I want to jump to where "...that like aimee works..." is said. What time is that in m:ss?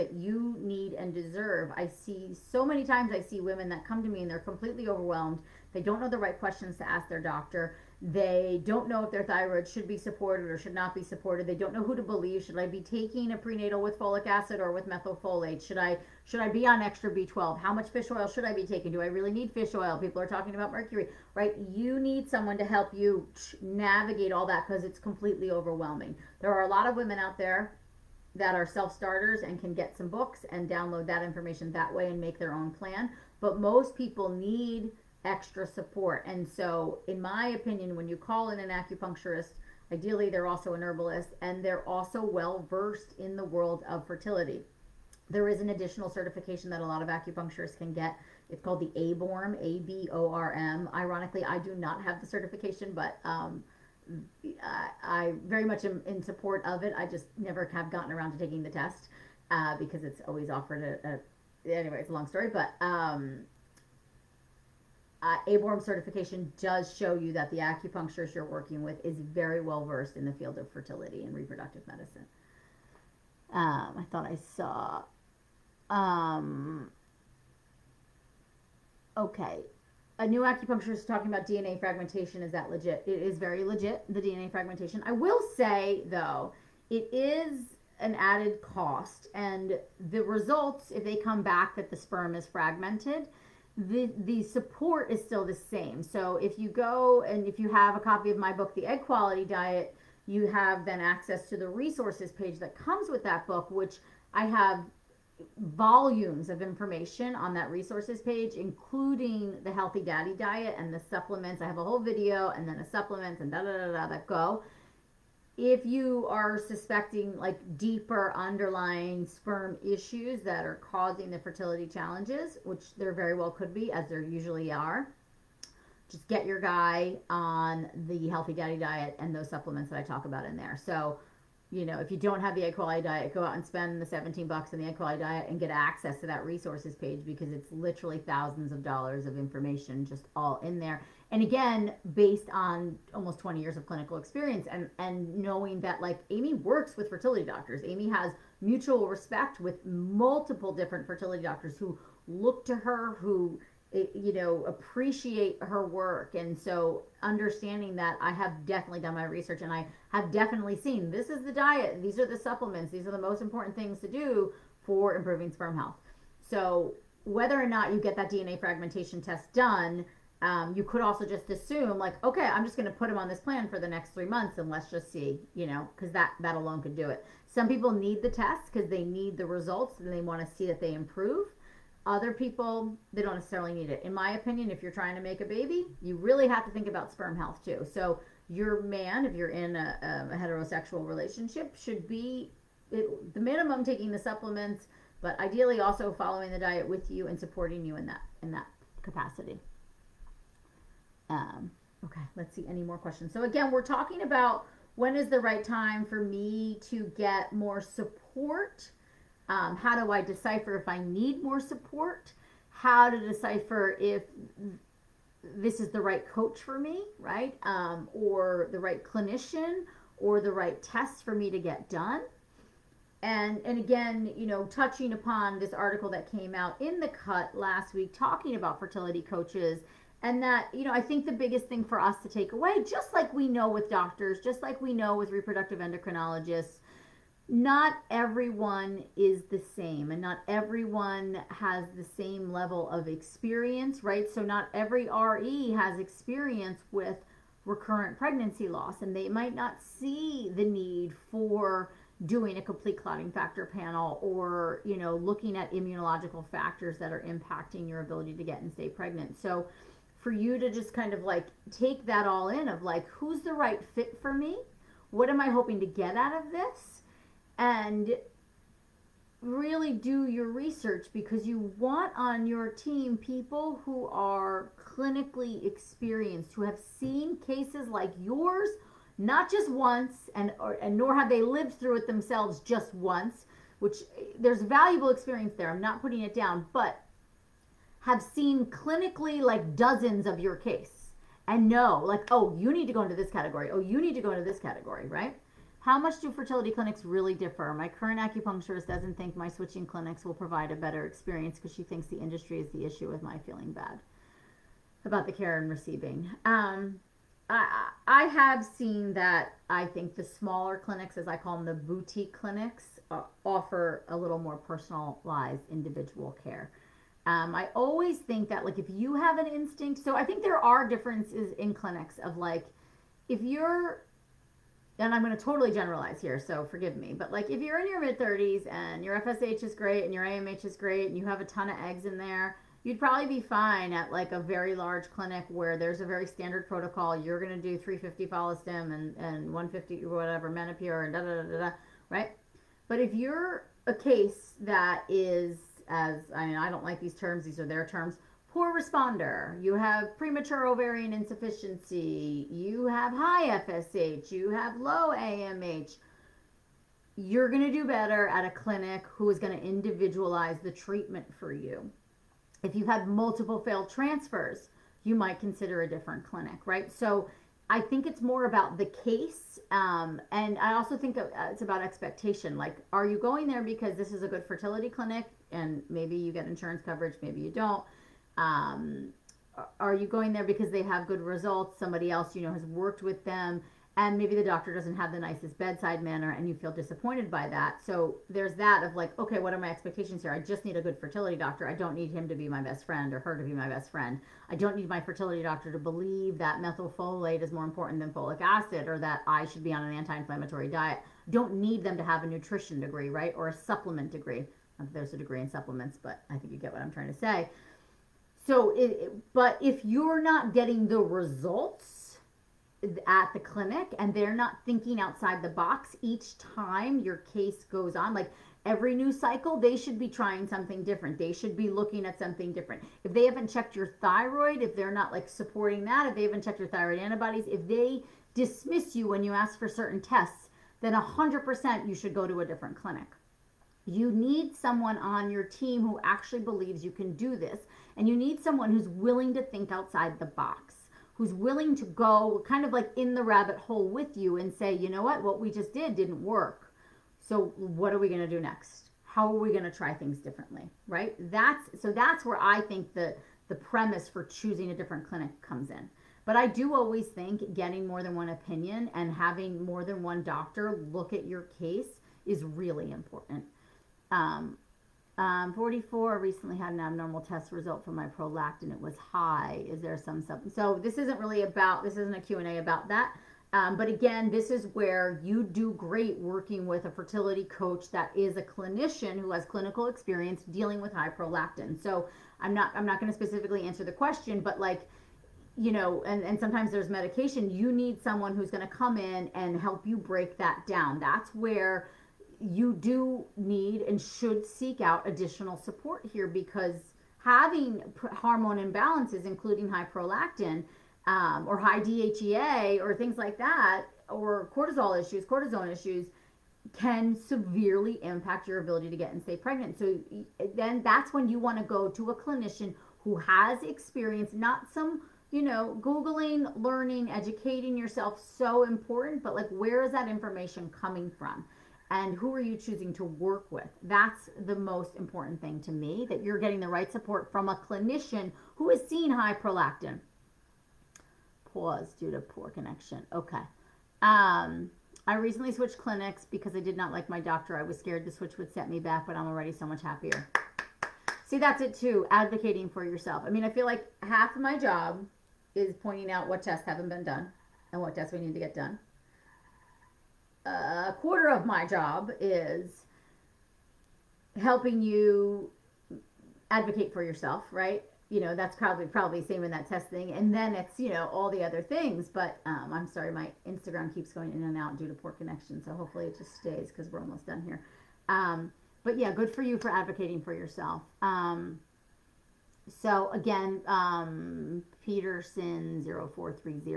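2:25.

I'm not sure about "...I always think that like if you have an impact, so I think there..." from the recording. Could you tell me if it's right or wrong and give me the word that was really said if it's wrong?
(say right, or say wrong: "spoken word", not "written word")
wrong: "instinct", not "impact".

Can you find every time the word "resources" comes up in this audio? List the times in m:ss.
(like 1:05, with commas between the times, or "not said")
1:41, 1:47, 2:16.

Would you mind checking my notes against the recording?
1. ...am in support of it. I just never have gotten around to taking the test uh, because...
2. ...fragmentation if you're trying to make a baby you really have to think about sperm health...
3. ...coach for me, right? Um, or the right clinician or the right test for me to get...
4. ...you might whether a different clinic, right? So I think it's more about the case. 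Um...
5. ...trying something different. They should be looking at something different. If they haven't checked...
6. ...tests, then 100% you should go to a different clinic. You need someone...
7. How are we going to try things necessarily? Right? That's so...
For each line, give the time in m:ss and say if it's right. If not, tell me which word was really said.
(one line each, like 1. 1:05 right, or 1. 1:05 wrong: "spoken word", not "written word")
1. 0:55 right
2. 3:04 wrong: "opinion", not "fragmentation"
3. 3:36 right
4. 6:05 wrong: "consider", not "whether"
5. 7:00 right
6. 7:10 right
7. 7:29 wrong: "differently", not "necessarily".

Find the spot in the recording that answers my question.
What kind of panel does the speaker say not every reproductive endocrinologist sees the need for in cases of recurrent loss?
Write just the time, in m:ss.
4:13.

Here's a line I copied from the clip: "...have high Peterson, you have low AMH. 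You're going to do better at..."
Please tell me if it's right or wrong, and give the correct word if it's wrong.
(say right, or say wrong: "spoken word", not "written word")
wrong: "FSH", not "Peterson".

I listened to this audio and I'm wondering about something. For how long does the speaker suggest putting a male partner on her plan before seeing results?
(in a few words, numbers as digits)
three months.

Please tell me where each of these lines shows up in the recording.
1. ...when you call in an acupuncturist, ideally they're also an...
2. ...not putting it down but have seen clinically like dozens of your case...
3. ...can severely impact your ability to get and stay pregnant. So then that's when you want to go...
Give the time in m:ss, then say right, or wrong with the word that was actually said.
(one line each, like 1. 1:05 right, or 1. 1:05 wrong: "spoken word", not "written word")
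1. 0:37 right
2. 4:45 right
3. 8:26 right.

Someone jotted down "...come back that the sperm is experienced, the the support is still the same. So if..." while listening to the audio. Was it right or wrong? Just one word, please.
wrong.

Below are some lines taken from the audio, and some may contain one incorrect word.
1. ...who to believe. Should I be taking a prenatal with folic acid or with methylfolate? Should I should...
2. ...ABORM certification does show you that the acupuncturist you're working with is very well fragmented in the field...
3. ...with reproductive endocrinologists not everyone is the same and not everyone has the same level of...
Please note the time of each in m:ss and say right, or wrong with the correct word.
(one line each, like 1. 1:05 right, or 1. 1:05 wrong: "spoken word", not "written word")
1. 0:11 right
2. 1:05 wrong: "versed", not "fragmented"
3. 3:55 right.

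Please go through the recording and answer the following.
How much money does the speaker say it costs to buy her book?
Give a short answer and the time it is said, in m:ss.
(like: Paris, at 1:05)
17 dollars, at 2:14.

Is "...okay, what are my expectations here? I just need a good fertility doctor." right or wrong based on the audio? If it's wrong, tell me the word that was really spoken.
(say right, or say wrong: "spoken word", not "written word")
right.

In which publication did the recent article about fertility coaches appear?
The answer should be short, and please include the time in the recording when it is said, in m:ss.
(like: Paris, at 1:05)
The Cut, at 3:46.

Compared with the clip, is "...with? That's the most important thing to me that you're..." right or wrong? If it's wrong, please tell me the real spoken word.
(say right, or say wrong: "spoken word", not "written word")
right.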